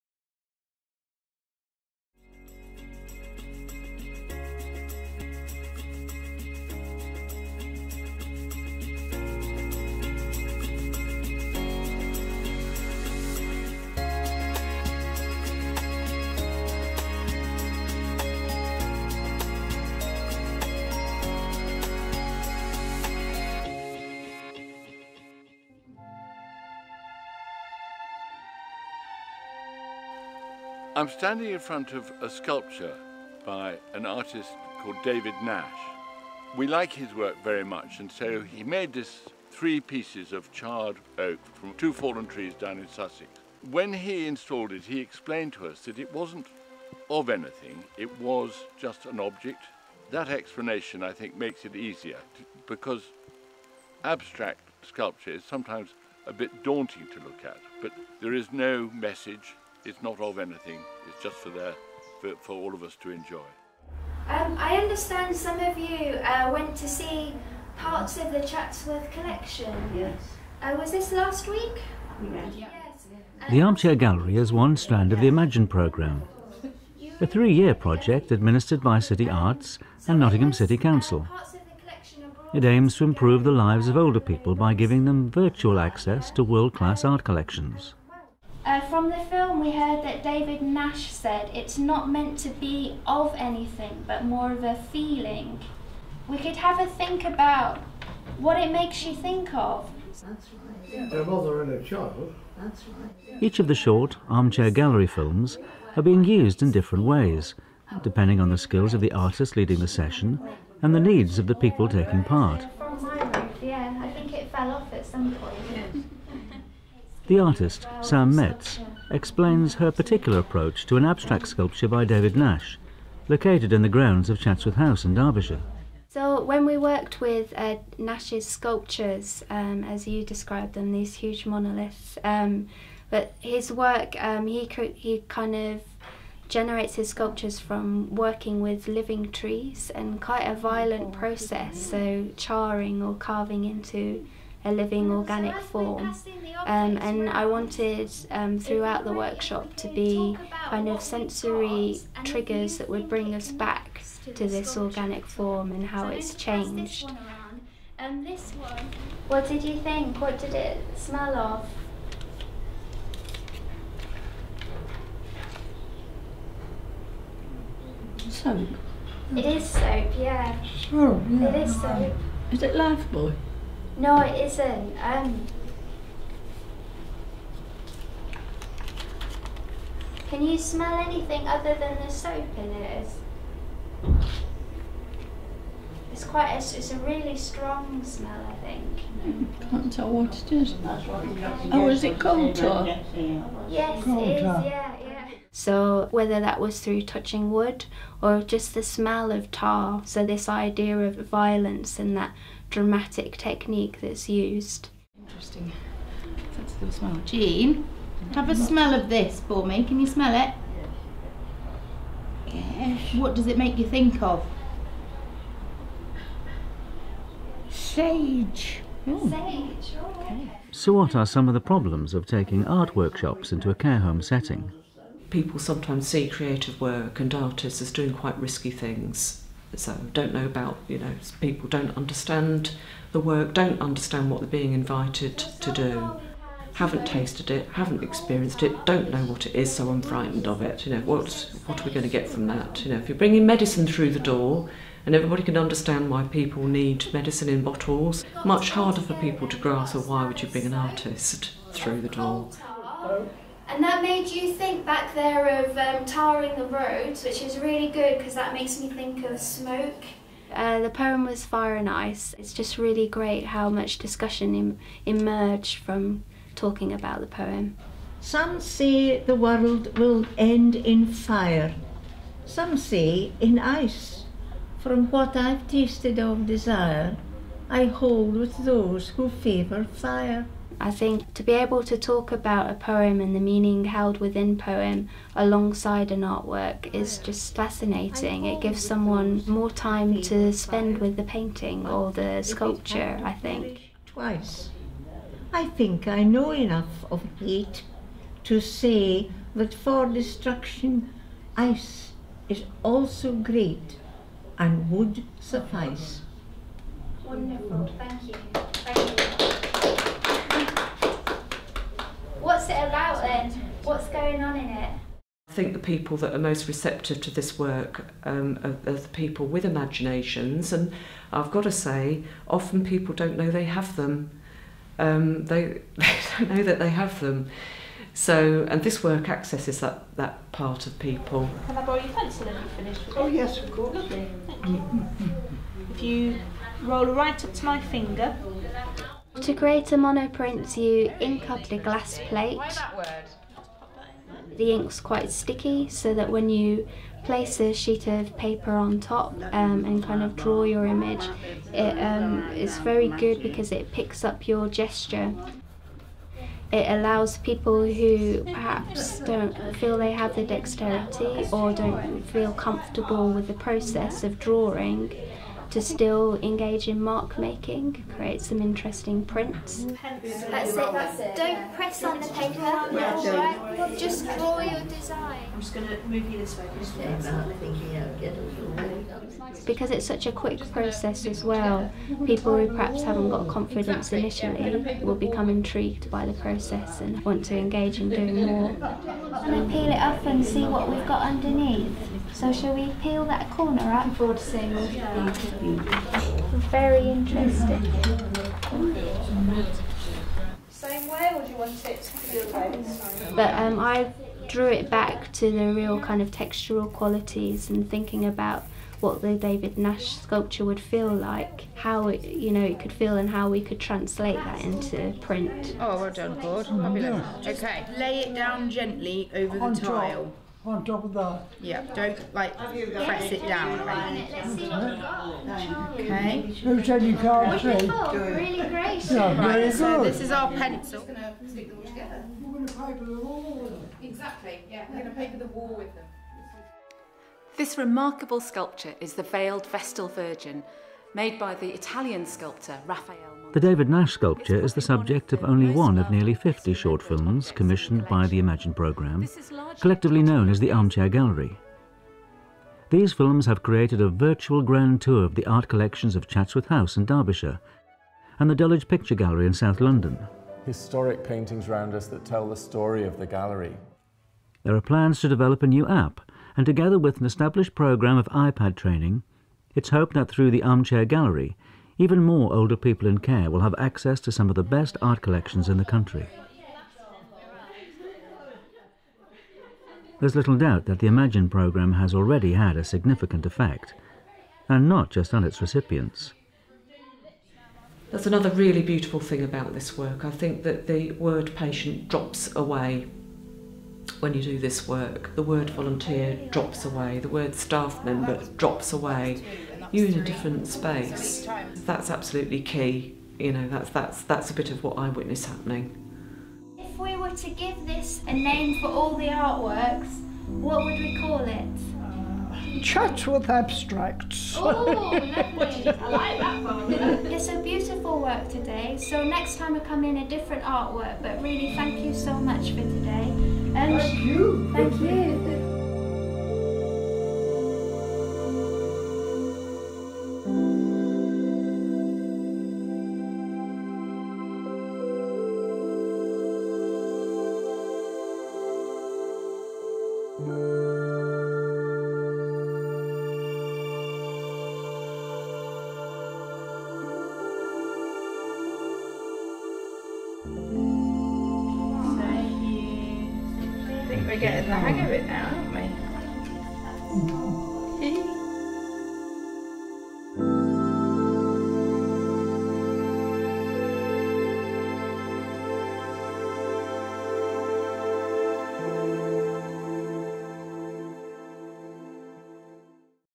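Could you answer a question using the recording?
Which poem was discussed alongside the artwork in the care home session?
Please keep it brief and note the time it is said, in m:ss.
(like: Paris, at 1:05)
Fire and Ice, at 4:21.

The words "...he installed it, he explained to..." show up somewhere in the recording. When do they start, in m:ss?
0:43.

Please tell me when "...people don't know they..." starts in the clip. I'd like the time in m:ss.
5:22.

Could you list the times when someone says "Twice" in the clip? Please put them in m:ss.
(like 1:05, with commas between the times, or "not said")
4:54.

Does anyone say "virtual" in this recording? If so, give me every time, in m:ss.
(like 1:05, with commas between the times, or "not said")
1:25, 7:34.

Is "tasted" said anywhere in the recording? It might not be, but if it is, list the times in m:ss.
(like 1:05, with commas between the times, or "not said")
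3:57, 4:35.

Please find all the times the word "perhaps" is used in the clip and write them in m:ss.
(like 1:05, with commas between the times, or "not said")
5:58, 6:22.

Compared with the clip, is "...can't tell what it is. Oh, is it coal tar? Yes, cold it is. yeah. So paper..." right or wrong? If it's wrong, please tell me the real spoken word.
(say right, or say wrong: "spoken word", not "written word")
wrong: "whether", not "paper".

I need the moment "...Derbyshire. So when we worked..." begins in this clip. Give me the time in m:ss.
2:05.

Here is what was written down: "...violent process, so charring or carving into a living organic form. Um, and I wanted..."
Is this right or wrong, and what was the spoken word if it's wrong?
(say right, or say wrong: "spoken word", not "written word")
right.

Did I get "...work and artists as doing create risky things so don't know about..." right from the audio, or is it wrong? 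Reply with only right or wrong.
wrong.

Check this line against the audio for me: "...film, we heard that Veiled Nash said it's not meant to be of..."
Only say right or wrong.
wrong.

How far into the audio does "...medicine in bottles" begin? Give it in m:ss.
4:07.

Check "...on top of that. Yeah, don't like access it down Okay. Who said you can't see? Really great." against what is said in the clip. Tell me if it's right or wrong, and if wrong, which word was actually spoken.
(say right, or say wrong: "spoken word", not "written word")
wrong: "press", not "access".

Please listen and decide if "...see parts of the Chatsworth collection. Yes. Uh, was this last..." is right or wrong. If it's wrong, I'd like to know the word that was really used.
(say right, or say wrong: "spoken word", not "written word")
right.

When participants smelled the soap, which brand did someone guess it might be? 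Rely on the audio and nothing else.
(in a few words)
Lifebuoy.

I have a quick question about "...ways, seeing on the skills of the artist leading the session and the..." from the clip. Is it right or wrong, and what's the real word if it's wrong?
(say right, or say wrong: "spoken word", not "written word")
wrong: "depending", not "seeing".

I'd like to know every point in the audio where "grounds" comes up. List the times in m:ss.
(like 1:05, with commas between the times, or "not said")
2:03.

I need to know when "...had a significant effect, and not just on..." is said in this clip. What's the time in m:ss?
8:02.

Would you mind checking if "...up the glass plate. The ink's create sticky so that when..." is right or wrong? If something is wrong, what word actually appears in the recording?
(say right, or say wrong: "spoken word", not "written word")
wrong: "quite", not "create".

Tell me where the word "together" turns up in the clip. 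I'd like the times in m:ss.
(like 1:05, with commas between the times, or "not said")
7:11, 7:46.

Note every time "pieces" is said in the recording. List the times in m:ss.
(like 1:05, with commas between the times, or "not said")
0:39.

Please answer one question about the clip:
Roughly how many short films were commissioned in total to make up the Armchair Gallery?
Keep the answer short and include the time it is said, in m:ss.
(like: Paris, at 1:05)
50, at 7:26.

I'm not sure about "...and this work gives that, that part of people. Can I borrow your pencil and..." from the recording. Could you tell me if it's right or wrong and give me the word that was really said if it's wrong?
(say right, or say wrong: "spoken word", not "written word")
wrong: "accesses", not "gives".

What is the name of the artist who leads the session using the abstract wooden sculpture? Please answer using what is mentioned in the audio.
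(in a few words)
Sam Metz.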